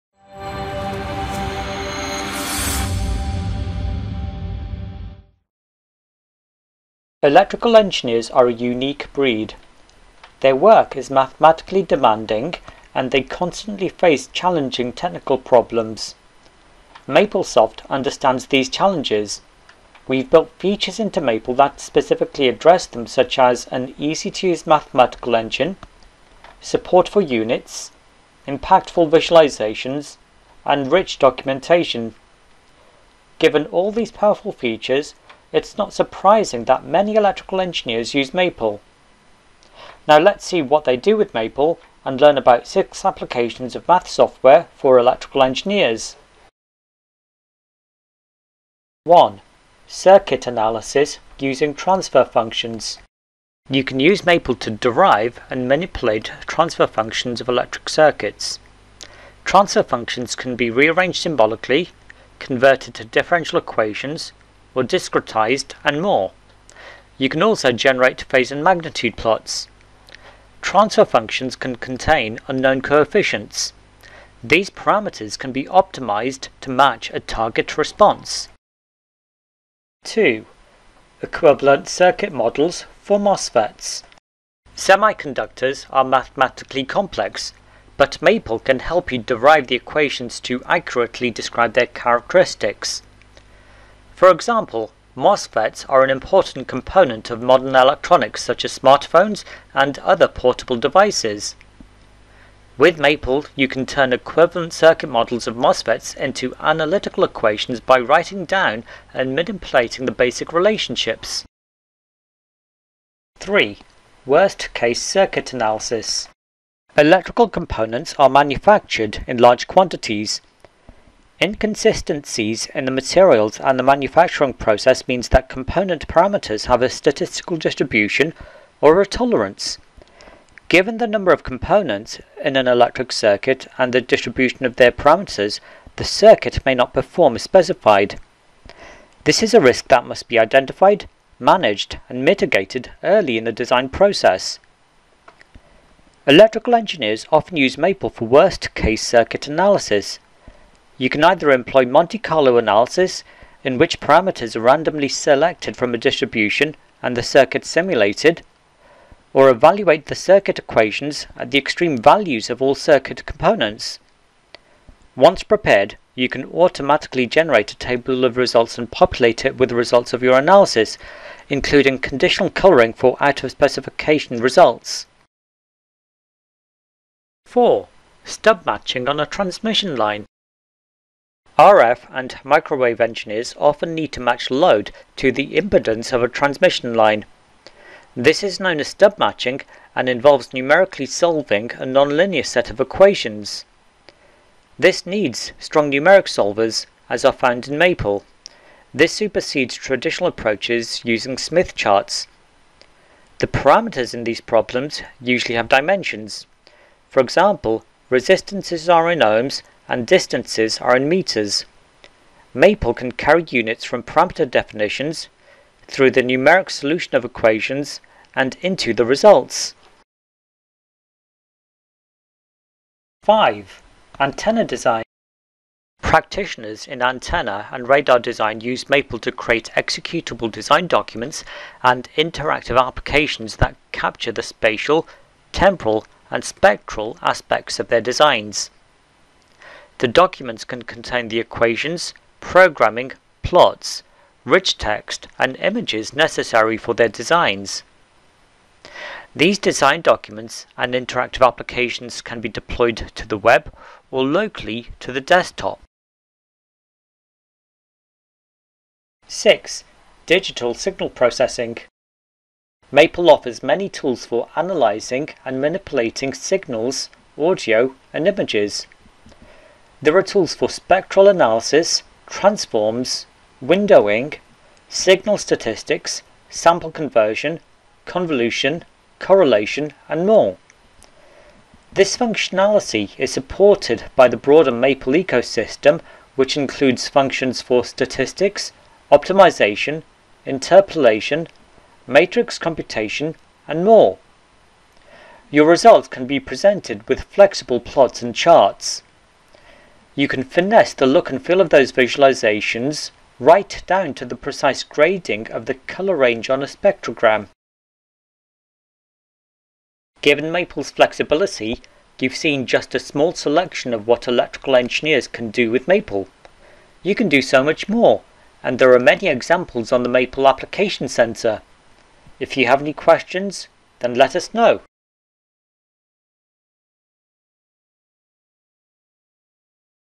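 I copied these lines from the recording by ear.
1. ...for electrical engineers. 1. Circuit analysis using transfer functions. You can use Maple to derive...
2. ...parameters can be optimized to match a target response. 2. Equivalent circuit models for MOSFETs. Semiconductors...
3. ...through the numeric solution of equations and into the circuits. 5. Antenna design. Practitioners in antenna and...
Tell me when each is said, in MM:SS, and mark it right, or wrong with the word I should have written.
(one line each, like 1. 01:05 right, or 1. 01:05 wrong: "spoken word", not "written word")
1. 00:44 right
2. 01:14 right
3. 03:35 wrong: "results", not "circuits".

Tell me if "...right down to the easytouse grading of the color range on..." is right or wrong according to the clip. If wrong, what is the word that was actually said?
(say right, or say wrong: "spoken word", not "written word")
wrong: "precise", not "easytouse".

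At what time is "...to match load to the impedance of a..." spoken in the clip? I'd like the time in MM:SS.
03:04.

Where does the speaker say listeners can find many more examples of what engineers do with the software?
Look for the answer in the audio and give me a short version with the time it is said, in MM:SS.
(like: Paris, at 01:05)
Maple Application Center, at 05:20.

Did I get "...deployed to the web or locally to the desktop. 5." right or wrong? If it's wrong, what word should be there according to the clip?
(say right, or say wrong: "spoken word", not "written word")
wrong: "6", not "5".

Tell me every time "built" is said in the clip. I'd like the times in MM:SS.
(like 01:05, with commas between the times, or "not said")
00:20.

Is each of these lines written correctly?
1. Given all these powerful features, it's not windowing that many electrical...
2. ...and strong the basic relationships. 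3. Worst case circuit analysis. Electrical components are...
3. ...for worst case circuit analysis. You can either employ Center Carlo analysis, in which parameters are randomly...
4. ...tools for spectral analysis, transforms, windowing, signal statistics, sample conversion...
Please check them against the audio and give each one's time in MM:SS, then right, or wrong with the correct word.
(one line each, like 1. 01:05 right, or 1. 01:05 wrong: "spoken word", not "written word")
1. 00:33 wrong: "surprising", not "windowing"
2. 01:49 wrong: "manipulating", not "strong"
3. 02:28 wrong: "Monte", not "Center"
4. 04:30 right.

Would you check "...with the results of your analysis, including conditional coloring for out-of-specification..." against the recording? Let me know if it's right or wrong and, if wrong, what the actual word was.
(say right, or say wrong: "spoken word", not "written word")
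right.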